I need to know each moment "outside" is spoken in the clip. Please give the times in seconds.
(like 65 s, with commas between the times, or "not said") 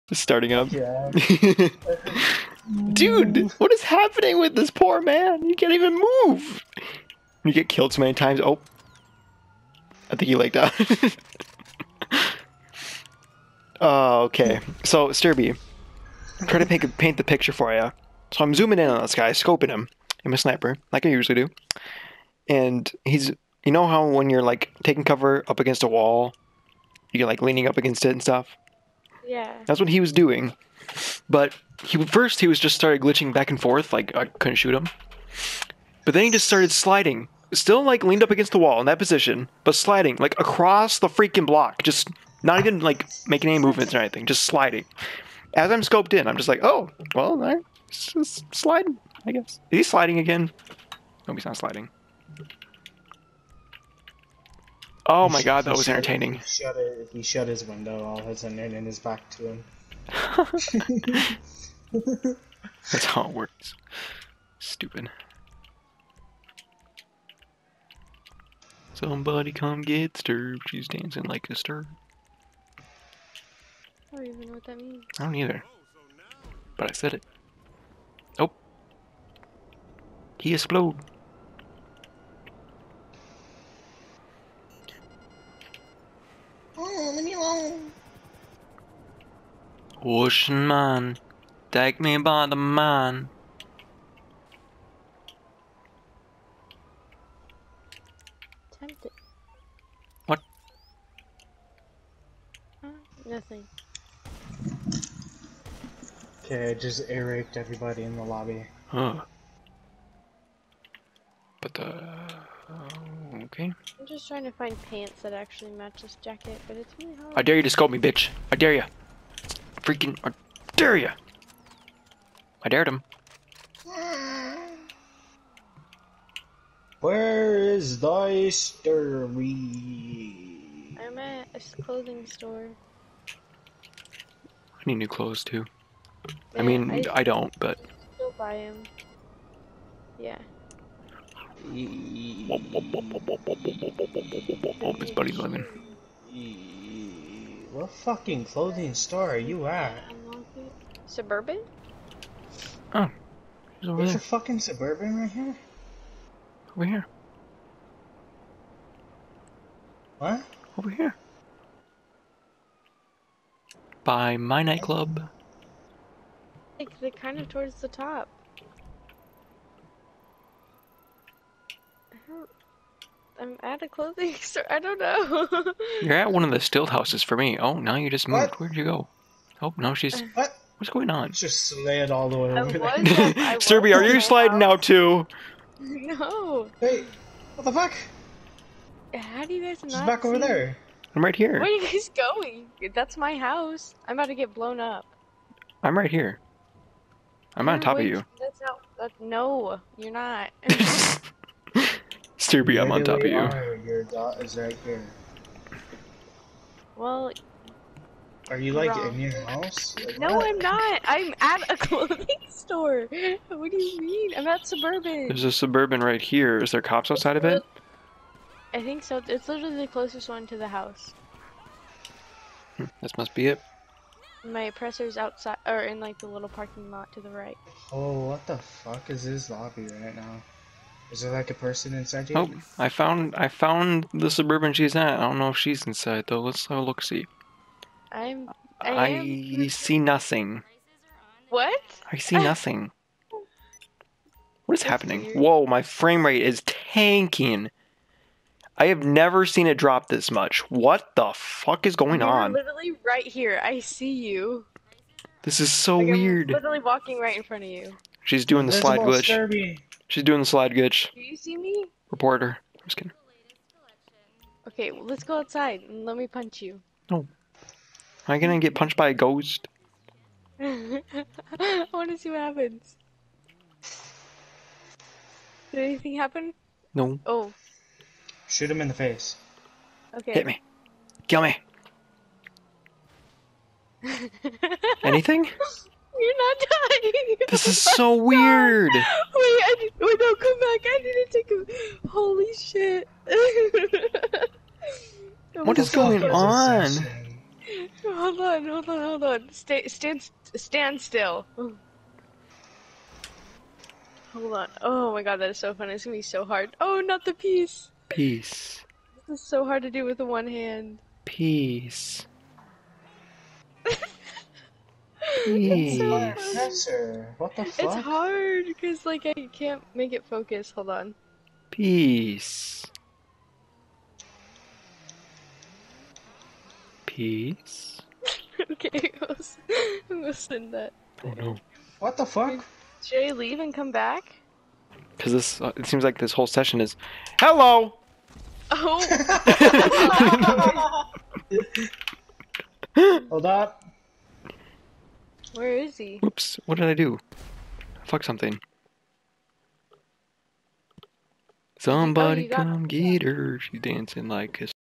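217 s, 225 s, 265 s.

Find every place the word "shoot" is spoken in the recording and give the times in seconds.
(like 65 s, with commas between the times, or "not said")
34 s, 278 s.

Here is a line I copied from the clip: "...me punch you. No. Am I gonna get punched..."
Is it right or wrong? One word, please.
right.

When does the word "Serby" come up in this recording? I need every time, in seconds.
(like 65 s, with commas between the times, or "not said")
183 s.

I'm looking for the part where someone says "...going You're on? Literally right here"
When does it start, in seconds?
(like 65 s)
251 s.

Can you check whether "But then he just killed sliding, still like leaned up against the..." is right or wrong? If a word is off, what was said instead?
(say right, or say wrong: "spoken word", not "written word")
wrong: "started", not "killed".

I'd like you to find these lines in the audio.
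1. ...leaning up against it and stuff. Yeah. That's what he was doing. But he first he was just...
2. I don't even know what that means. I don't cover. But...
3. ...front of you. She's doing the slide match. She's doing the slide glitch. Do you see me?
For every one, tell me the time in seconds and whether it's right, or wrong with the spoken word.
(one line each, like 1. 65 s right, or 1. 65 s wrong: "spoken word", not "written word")
1. 27 s right
2. 74 s wrong: "either", not "cover"
3. 257 s wrong: "glitch", not "match".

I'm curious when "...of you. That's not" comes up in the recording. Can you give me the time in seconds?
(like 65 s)
197 s.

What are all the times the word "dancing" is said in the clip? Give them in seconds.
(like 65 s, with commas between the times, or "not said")
70 s, 353 s.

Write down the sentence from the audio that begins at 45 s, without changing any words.
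As I'm scoped in, I'm just like, oh, well, right, just sliding, I guess.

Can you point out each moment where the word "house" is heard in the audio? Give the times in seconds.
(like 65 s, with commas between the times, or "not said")
176 s, 193 s, 209 s, 220 s.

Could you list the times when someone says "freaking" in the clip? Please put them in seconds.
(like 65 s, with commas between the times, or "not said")
41 s, 119 s.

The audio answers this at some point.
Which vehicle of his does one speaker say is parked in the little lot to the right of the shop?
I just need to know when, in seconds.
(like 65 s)
224 s.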